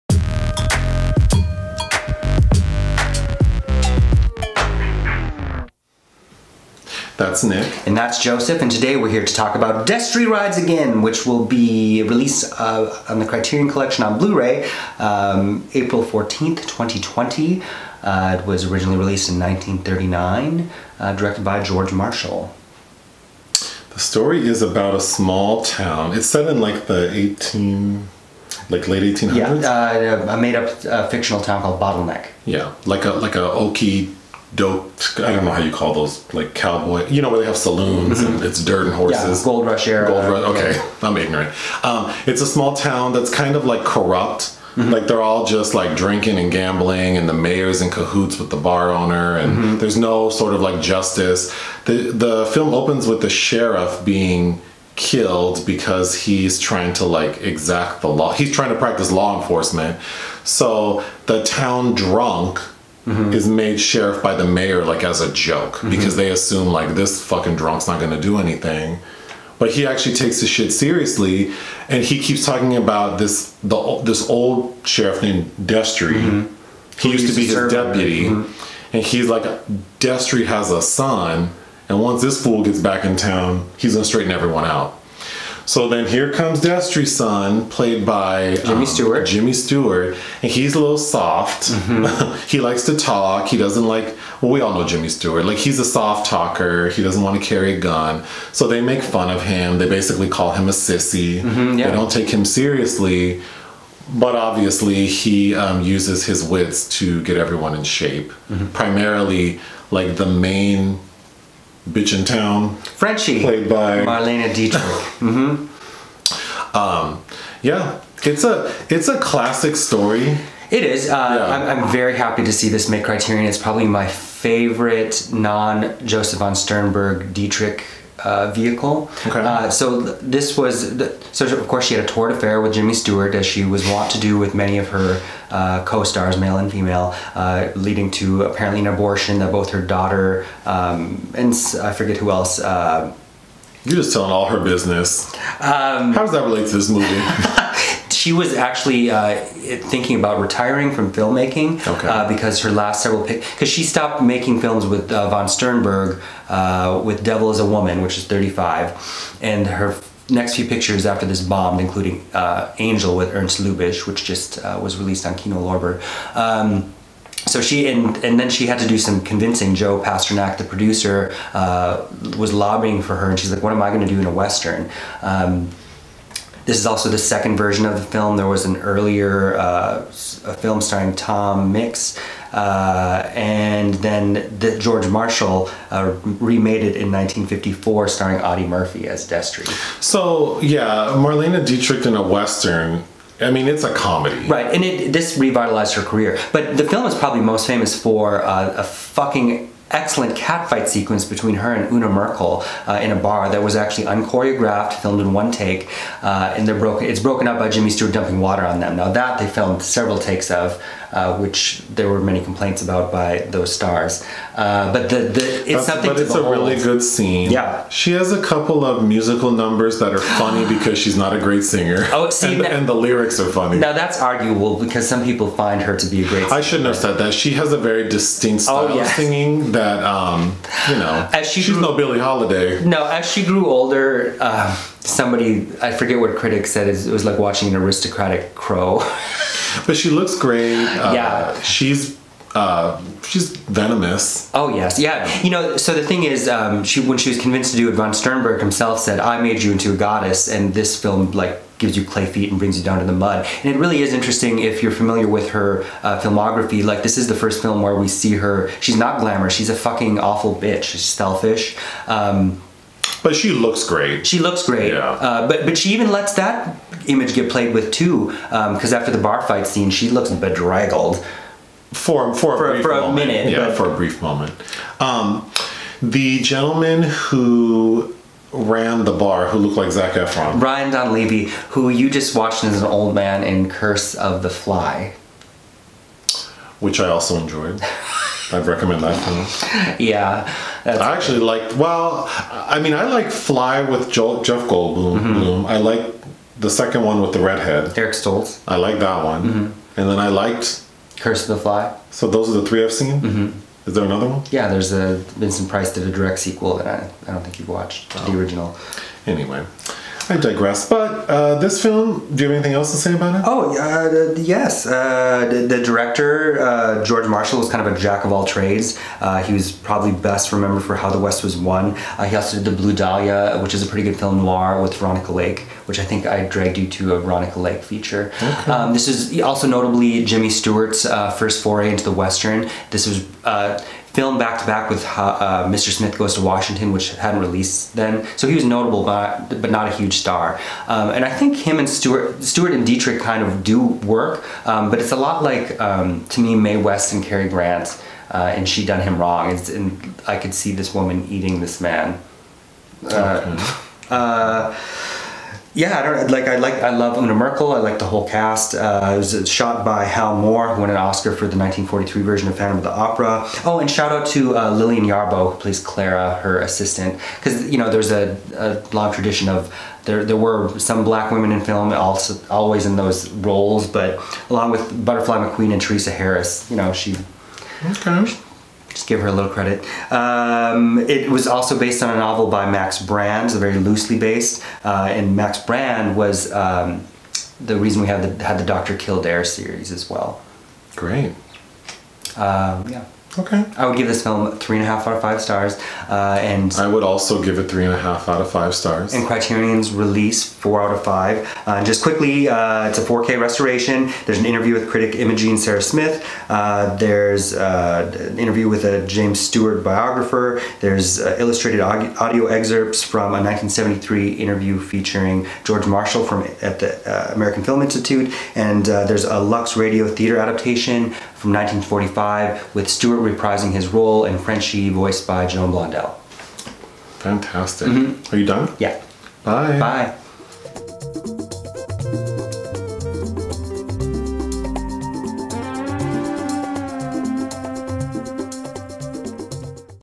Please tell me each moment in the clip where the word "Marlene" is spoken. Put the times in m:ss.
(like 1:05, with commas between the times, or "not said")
1:53, 3:11.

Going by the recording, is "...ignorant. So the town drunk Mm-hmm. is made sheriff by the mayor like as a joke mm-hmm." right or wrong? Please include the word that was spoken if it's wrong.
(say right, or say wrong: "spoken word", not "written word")
wrong: "enforcement", not "ignorant".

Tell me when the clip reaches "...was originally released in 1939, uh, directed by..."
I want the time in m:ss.
0:18.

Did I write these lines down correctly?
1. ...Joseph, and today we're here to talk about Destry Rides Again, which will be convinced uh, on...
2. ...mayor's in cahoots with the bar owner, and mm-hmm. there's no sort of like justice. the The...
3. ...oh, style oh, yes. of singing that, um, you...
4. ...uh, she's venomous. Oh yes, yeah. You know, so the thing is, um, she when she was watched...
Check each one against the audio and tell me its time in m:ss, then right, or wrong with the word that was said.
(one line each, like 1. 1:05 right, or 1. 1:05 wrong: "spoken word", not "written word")
1. 0:08 wrong: "released", not "convinced"
2. 0:47 right
3. 3:48 right
4. 4:02 wrong: "convinced", not "watched".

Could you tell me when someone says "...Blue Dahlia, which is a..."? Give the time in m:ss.
5:22.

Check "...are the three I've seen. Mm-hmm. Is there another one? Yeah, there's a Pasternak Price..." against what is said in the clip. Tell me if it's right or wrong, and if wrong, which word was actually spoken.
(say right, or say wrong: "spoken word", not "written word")
wrong: "Vincent", not "Pasternak".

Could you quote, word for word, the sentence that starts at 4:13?
And it really is interesting if you're familiar with her uh, filmography.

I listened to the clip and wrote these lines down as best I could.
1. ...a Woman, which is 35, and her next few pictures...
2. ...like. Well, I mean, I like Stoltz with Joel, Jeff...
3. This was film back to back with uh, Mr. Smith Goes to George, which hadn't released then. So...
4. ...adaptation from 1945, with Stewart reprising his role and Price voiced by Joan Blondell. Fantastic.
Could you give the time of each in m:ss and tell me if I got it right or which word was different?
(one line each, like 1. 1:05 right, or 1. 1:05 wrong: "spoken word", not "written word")
1. 2:37 right
2. 4:51 wrong: "Fly", not "Stoltz"
3. 5:32 wrong: "Washington", not "George"
4. 7:00 wrong: "Frenchy", not "Price".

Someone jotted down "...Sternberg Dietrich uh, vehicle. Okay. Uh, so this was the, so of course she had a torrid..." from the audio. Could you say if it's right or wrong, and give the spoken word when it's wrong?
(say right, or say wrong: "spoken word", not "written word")
right.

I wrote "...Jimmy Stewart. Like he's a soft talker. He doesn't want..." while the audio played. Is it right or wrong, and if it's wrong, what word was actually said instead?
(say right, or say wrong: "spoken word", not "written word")
right.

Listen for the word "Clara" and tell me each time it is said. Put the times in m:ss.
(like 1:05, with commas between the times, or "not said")
6:05.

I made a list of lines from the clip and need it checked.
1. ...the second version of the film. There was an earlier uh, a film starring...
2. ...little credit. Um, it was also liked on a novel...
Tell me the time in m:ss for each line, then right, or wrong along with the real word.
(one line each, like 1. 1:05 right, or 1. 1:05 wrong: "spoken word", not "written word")
1. 2:57 right
2. 6:19 wrong: "based", not "liked".